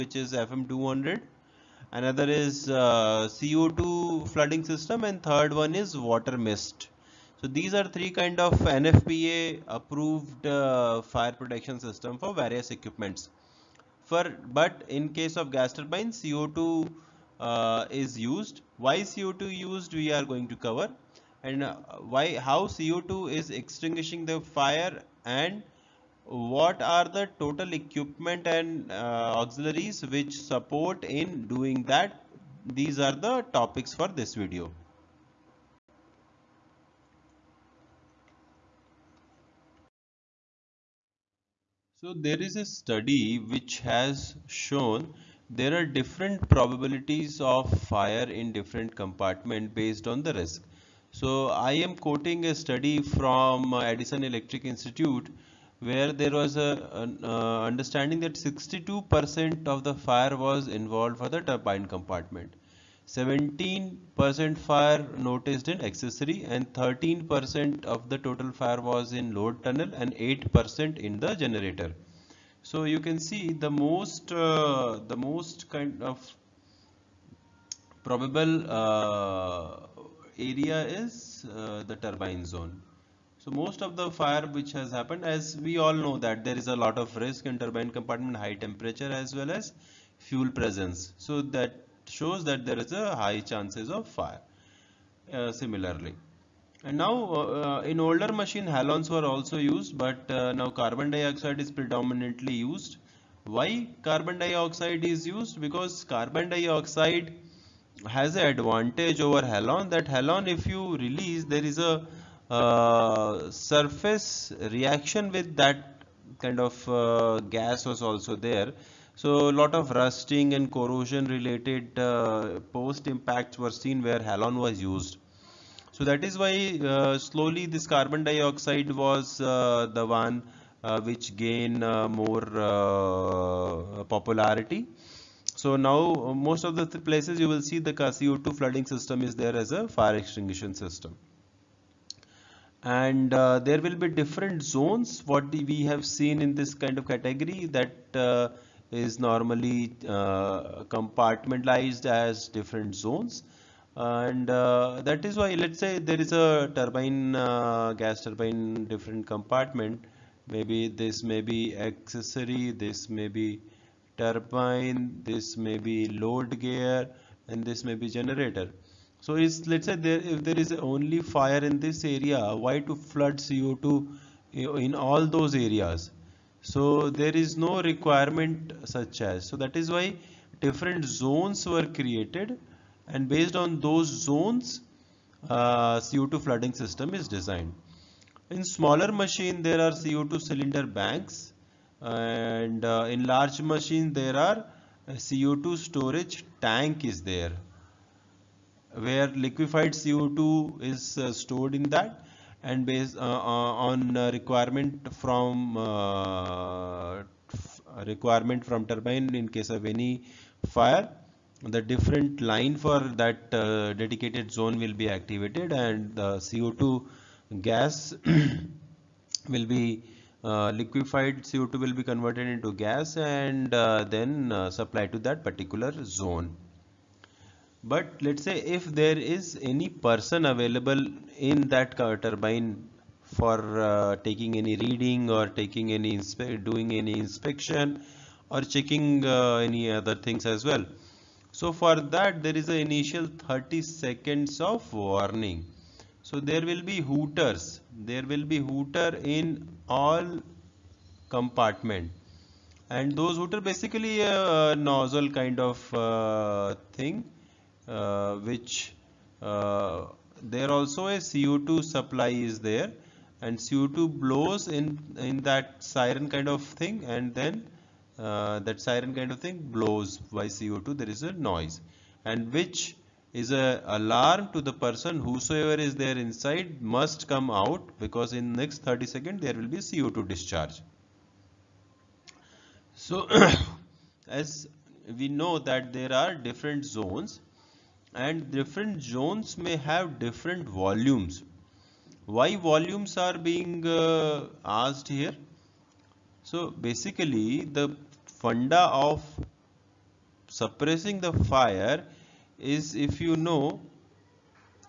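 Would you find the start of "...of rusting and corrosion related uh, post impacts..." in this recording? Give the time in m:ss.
1:59.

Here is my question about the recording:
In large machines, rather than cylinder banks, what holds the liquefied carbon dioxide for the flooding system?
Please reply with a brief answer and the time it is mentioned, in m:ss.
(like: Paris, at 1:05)
CO2 storage tank, at 3:15.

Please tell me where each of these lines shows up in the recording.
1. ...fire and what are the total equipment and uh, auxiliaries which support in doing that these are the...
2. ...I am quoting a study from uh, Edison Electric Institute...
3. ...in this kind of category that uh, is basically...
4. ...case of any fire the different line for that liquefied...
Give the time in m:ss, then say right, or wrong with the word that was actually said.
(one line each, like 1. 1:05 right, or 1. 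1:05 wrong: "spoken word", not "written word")
1. 0:24 right
2. 0:51 right
3. 2:26 wrong: "normally", not "basically"
4. 3:29 wrong: "dedicated", not "liquefied".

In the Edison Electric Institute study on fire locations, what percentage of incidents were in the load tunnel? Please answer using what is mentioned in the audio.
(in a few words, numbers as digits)
13%.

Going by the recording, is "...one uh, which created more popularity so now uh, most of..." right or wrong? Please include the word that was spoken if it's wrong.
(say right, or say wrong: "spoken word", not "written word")
wrong: "gained", not "created".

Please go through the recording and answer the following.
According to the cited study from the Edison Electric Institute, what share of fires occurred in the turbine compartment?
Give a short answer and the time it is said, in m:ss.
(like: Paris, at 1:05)
62%, at 0:58.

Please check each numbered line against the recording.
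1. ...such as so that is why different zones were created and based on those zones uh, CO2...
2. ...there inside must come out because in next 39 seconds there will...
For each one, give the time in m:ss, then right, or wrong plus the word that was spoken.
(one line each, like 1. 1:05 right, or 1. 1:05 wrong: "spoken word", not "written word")
1. 2:58 right
2. 4:35 wrong: "30", not "39".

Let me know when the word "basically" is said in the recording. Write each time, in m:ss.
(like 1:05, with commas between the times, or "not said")
4:13, 4:56.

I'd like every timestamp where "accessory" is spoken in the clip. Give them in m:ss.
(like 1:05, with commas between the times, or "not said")
1:05, 2:41.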